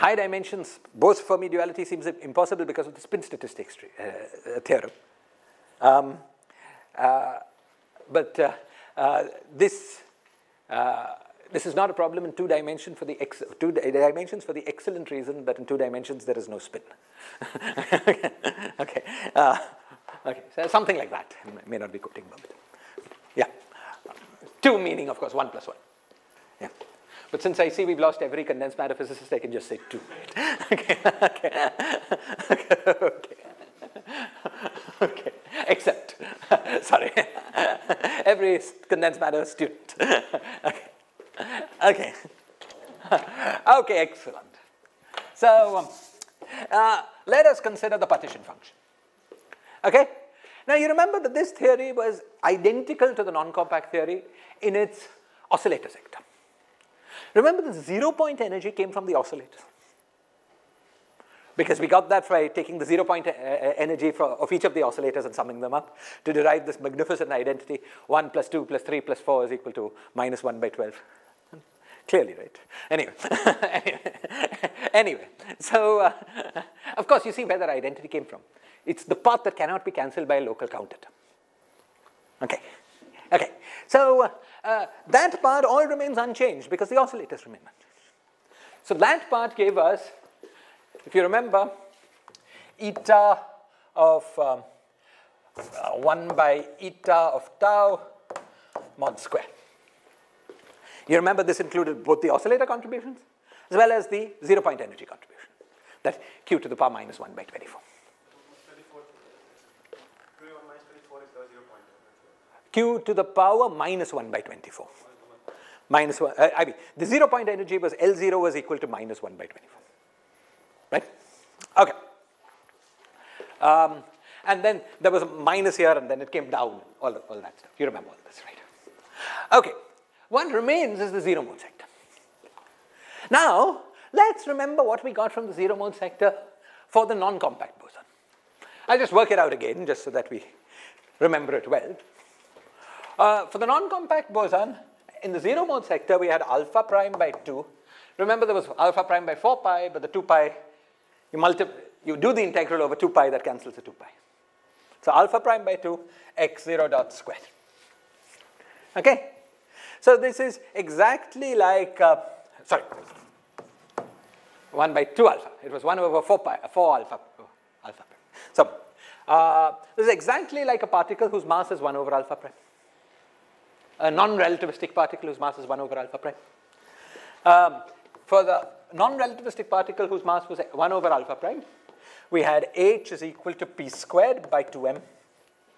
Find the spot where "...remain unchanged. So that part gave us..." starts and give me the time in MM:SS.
01:27.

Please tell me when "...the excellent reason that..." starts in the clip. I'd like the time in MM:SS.
00:14.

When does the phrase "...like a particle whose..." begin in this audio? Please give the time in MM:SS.
02:50.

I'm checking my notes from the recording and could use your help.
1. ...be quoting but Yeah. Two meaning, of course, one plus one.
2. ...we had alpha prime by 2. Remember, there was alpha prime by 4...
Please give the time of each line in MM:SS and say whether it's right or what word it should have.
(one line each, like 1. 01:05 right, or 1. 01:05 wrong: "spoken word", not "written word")
1. 00:21 right
2. 02:26 right.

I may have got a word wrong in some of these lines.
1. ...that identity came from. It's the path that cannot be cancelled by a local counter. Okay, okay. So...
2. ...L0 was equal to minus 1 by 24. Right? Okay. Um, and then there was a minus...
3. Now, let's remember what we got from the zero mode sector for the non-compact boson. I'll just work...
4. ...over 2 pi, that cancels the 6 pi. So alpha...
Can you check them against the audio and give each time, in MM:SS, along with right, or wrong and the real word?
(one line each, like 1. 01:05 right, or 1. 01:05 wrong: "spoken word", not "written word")
1. 01:17 right
2. 01:57 right
3. 02:13 right
4. 02:32 wrong: "2", not "6".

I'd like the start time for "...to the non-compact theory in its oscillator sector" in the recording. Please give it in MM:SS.
00:53.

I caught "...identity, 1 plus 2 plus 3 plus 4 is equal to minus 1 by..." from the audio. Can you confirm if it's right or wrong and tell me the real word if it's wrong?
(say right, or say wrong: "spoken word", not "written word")
right.